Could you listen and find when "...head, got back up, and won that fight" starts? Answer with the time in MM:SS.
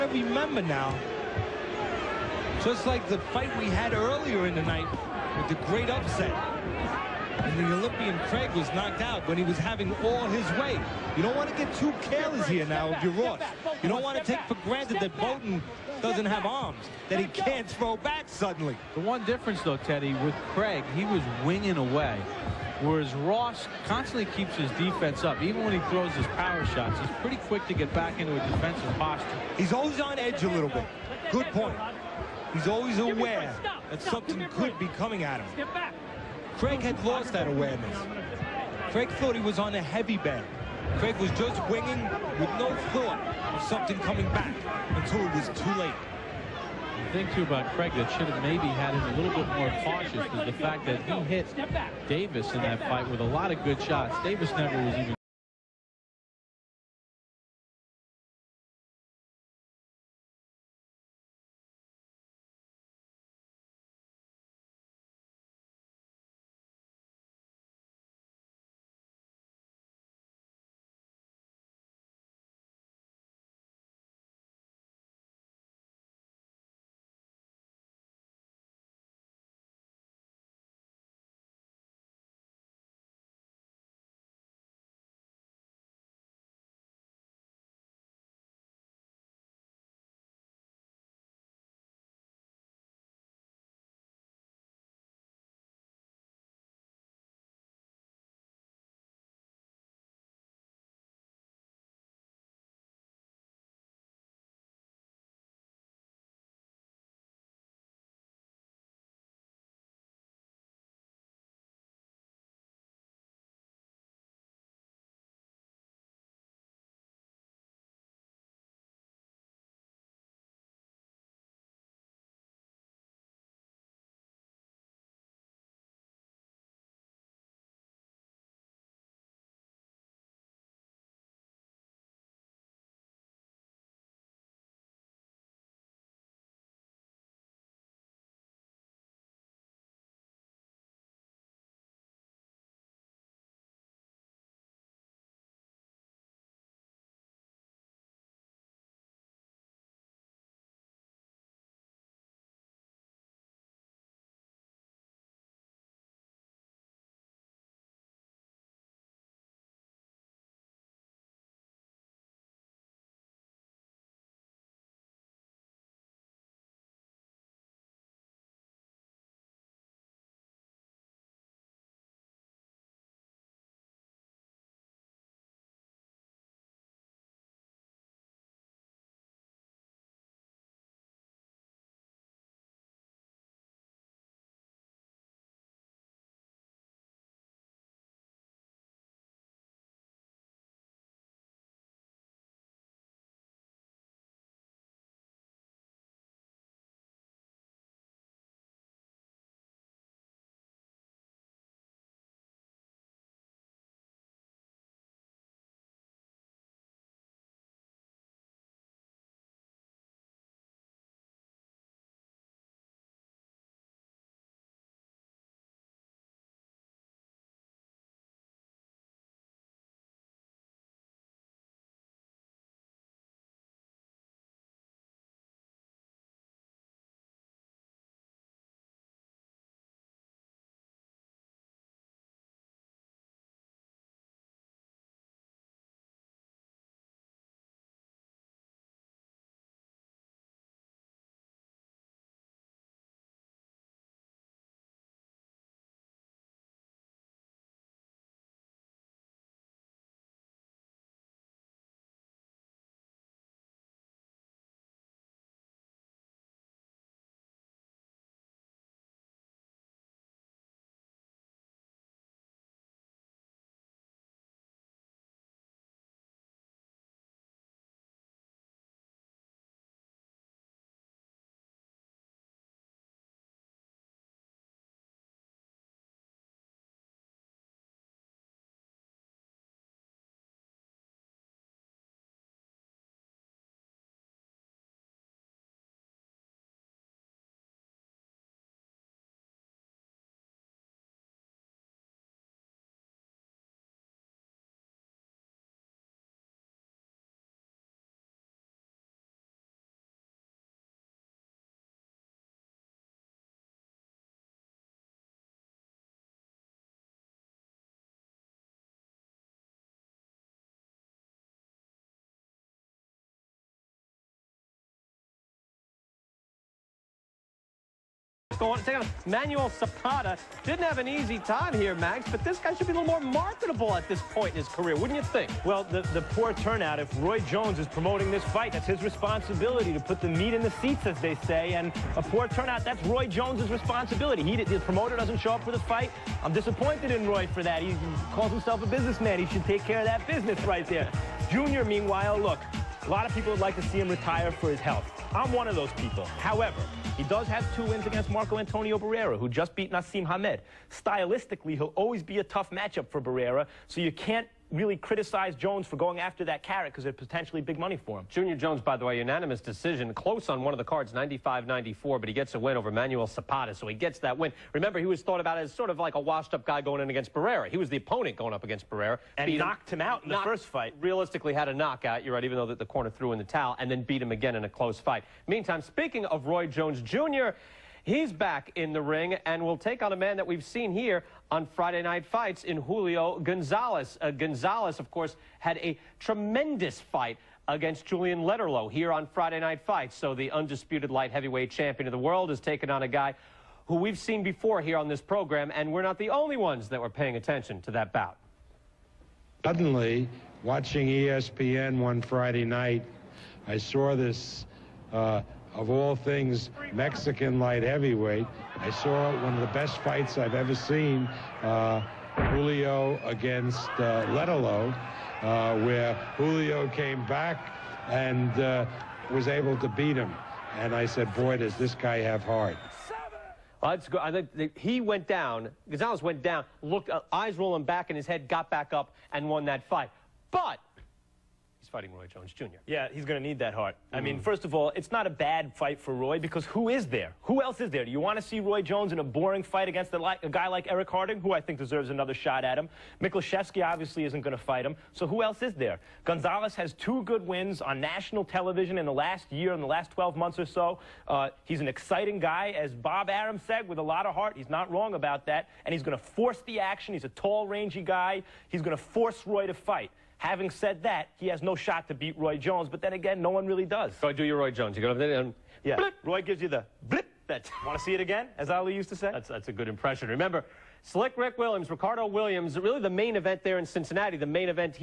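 07:08.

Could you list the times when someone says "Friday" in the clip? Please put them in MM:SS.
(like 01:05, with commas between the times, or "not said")
06:21, 06:29, 06:42.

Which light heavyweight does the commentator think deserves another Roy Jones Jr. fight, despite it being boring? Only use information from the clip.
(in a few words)
Eric Harding.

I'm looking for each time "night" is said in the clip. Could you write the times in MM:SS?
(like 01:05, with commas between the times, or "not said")
00:04, 06:22, 06:29, 06:42.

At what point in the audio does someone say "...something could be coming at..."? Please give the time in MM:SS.
00:34.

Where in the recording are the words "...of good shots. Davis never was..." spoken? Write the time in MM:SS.
00:53.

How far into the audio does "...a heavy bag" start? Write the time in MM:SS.
00:39.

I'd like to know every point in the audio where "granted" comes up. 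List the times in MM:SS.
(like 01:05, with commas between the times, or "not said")
00:14.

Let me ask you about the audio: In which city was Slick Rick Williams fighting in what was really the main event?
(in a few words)
Cincinnati.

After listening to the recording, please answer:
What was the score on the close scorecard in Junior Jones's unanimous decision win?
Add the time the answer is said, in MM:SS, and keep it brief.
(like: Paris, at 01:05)
95-94, at 06:01.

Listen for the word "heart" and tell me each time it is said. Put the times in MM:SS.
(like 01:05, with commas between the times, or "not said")
07:02, 07:13, 07:34.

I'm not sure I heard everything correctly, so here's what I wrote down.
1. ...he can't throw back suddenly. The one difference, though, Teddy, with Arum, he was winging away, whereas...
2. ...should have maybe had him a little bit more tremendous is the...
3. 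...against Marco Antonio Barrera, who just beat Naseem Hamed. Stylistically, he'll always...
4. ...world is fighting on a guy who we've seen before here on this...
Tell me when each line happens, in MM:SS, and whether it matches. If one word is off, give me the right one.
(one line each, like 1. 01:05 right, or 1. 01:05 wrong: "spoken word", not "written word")
1. 00:17 wrong: "Craig", not "Arum"
2. 00:48 wrong: "cautious", not "tremendous"
3. 05:48 right
4. 06:32 wrong: "taking", not "fighting".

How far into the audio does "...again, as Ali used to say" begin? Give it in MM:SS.
07:48.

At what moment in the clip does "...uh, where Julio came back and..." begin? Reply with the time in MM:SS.
06:55.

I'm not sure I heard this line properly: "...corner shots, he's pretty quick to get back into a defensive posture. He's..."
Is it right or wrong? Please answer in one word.
wrong.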